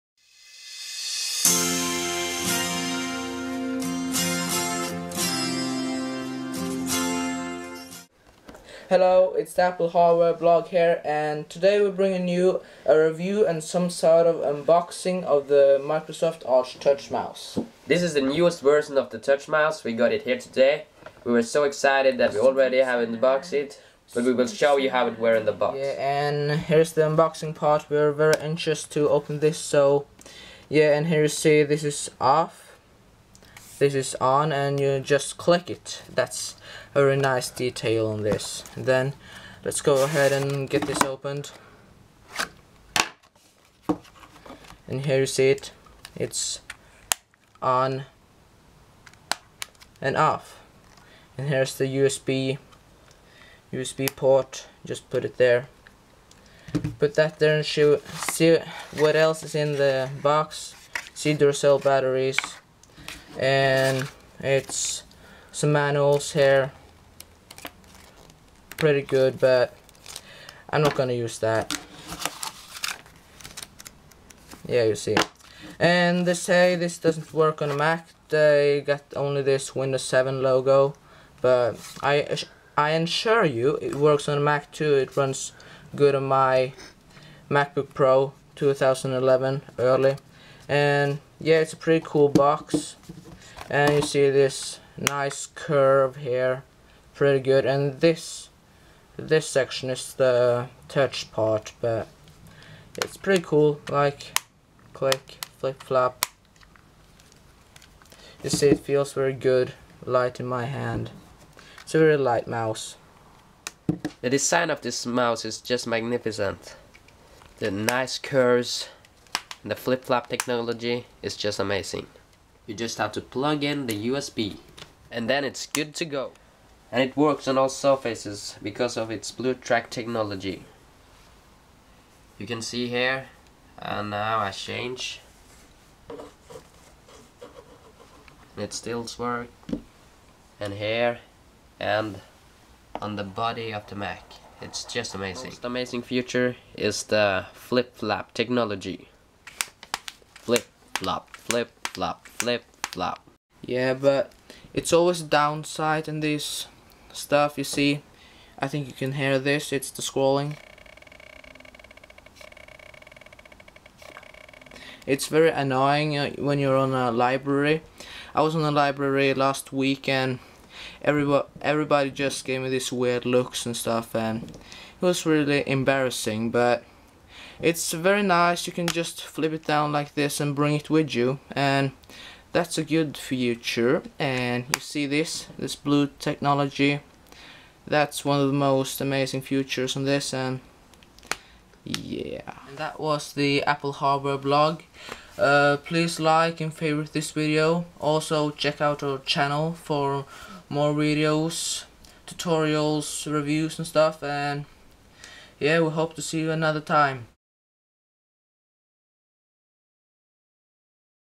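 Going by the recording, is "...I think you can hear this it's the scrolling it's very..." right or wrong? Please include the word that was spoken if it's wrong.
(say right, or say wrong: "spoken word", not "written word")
right.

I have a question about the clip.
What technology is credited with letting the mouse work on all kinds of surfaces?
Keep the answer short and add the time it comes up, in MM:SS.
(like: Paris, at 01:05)
BlueTrack, at 02:09.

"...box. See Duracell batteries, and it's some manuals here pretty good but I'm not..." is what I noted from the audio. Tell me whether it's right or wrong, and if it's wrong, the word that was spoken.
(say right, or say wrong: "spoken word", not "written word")
right.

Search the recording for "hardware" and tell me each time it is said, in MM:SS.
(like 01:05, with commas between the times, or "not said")
00:09, 03:13.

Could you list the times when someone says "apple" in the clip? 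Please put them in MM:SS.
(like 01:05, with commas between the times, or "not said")
00:09, 03:13.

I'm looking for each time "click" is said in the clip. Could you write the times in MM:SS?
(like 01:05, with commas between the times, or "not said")
00:35, 01:44.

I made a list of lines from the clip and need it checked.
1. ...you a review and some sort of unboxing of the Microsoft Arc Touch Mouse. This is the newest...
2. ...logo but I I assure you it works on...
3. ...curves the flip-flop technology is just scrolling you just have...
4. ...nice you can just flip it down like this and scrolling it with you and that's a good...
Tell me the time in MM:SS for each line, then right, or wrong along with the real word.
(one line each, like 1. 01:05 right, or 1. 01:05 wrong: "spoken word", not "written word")
1. 00:12 right
2. 01:20 right
3. 01:58 wrong: "amazing", not "scrolling"
4. 02:58 wrong: "bring", not "scrolling".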